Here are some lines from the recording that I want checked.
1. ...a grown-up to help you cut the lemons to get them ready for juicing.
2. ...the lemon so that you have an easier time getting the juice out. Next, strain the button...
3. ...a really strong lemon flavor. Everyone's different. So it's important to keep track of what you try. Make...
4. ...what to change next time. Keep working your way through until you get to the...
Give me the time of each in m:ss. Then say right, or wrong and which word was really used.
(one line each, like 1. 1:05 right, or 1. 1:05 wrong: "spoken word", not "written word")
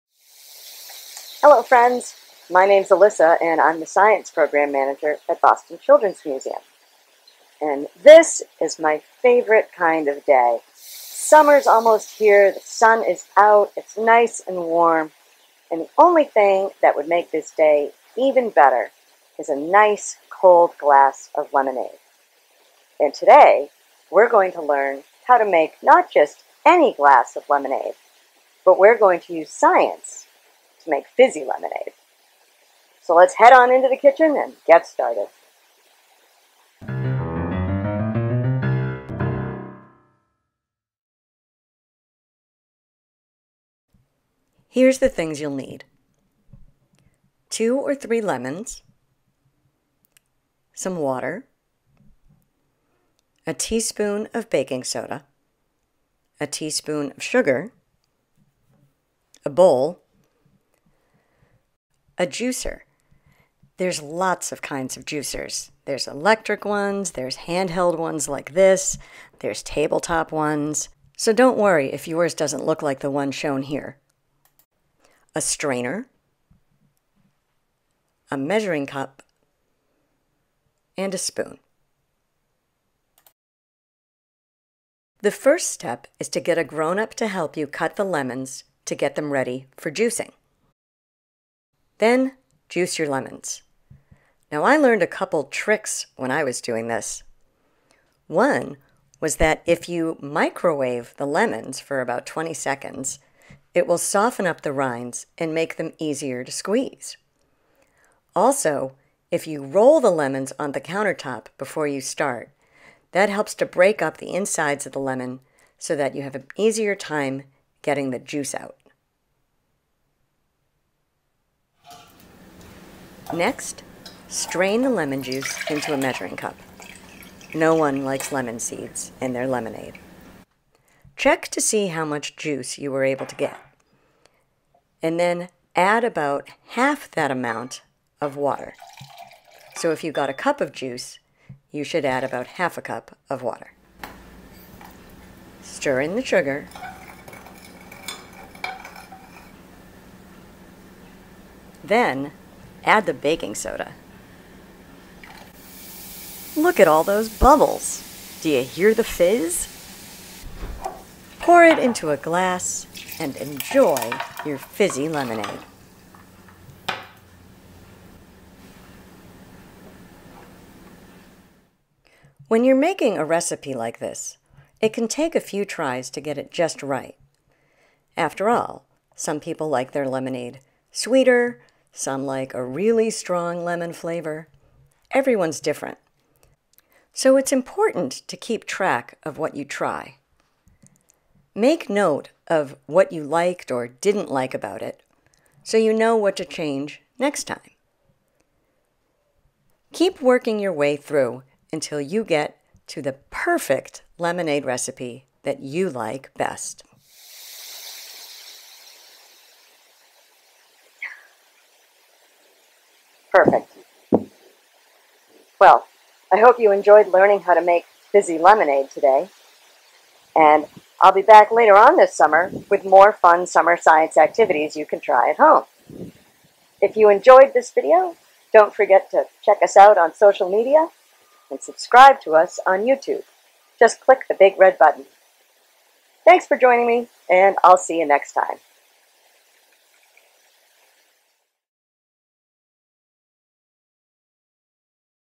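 1. 1:26 right
2. 1:54 wrong: "lemon", not "button"
3. 3:02 right
4. 3:16 right.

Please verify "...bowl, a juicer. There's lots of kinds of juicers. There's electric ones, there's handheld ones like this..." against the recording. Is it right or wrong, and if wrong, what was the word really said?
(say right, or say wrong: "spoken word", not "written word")
right.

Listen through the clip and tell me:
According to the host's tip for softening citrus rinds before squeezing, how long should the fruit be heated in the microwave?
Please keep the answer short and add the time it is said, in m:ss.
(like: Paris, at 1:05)
20 seconds, at 1:42.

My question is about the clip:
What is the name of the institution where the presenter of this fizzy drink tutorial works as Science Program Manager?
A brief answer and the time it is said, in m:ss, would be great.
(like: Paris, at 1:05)
Boston Children's Museum, at 0:05.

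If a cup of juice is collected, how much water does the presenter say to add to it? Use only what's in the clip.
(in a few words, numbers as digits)
half a cup.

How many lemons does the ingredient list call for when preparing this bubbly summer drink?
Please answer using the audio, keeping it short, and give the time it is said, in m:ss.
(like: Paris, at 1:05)
2 or 3, at 0:47.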